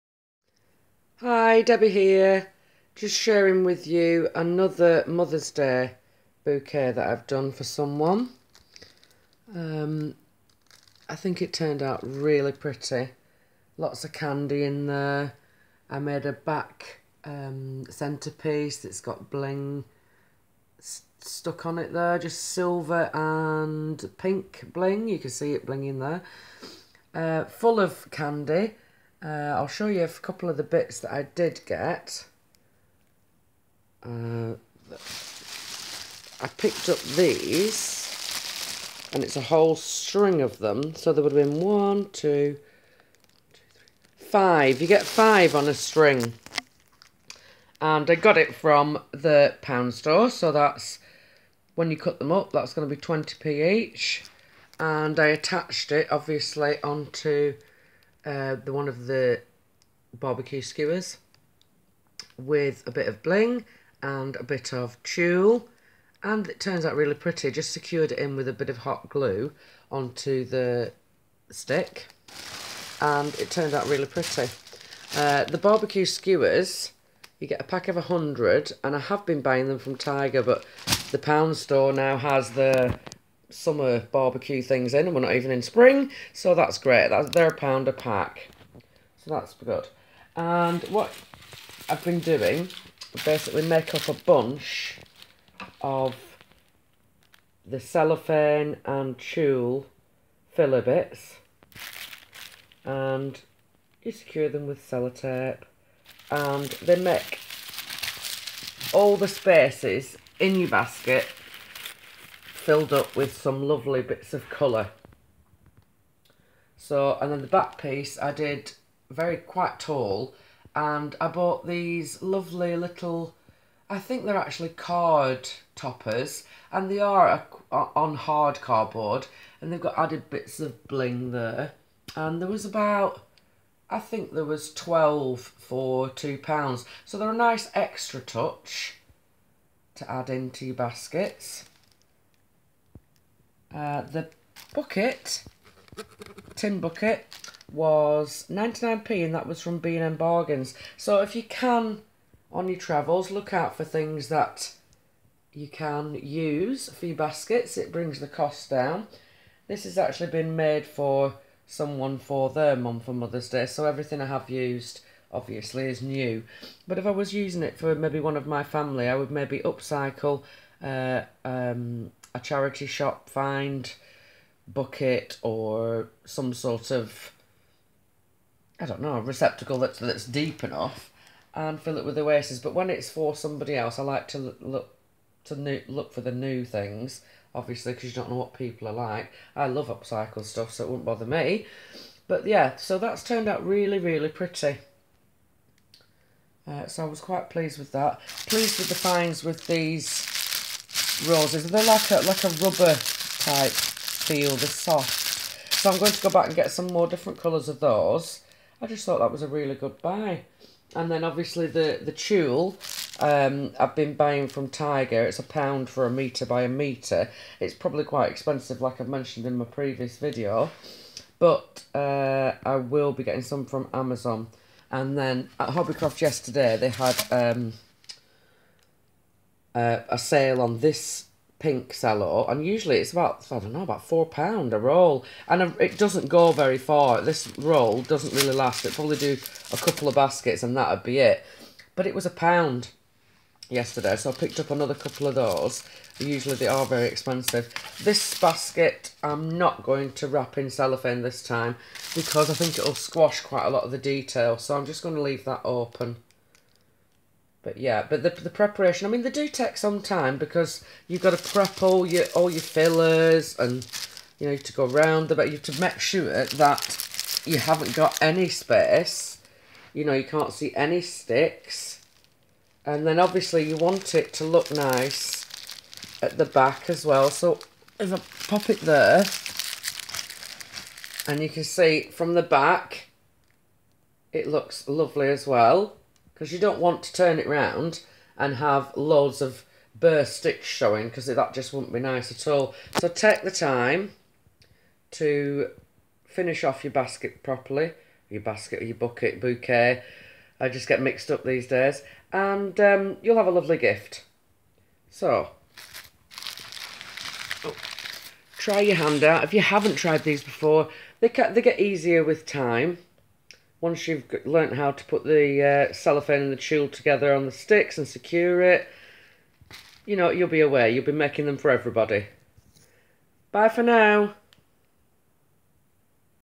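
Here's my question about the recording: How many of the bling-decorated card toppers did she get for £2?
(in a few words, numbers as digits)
12.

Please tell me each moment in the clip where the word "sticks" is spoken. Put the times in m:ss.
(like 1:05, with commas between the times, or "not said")
1:11, 4:31, 4:50, 5:17.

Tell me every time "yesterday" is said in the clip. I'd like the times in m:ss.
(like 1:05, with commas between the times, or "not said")
3:46, 4:03.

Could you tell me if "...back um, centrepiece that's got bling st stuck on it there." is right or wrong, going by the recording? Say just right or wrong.
right.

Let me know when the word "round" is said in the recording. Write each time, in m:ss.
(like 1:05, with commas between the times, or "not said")
4:24, 4:47.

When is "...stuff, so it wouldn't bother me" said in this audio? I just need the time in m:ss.
3:10.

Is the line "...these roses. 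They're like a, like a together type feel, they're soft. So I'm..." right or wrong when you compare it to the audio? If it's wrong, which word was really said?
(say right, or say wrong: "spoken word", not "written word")
wrong: "rubber", not "together".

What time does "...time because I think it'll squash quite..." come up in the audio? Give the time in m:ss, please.
4:11.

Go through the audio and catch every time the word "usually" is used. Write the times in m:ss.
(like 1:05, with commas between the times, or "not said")
3:52, 4:06.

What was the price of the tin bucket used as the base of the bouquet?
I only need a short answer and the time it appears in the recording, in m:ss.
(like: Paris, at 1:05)
99p, at 2:28.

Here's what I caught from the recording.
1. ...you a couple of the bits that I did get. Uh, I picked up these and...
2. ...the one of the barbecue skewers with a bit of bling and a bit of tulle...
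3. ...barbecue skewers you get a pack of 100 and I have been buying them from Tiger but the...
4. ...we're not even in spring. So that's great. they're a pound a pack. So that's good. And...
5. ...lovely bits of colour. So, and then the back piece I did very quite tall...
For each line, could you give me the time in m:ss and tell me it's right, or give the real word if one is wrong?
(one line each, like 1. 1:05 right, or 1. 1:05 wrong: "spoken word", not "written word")
1. 0:29 right
2. 0:58 right
3. 1:15 right
4. 1:25 right
5. 1:53 right.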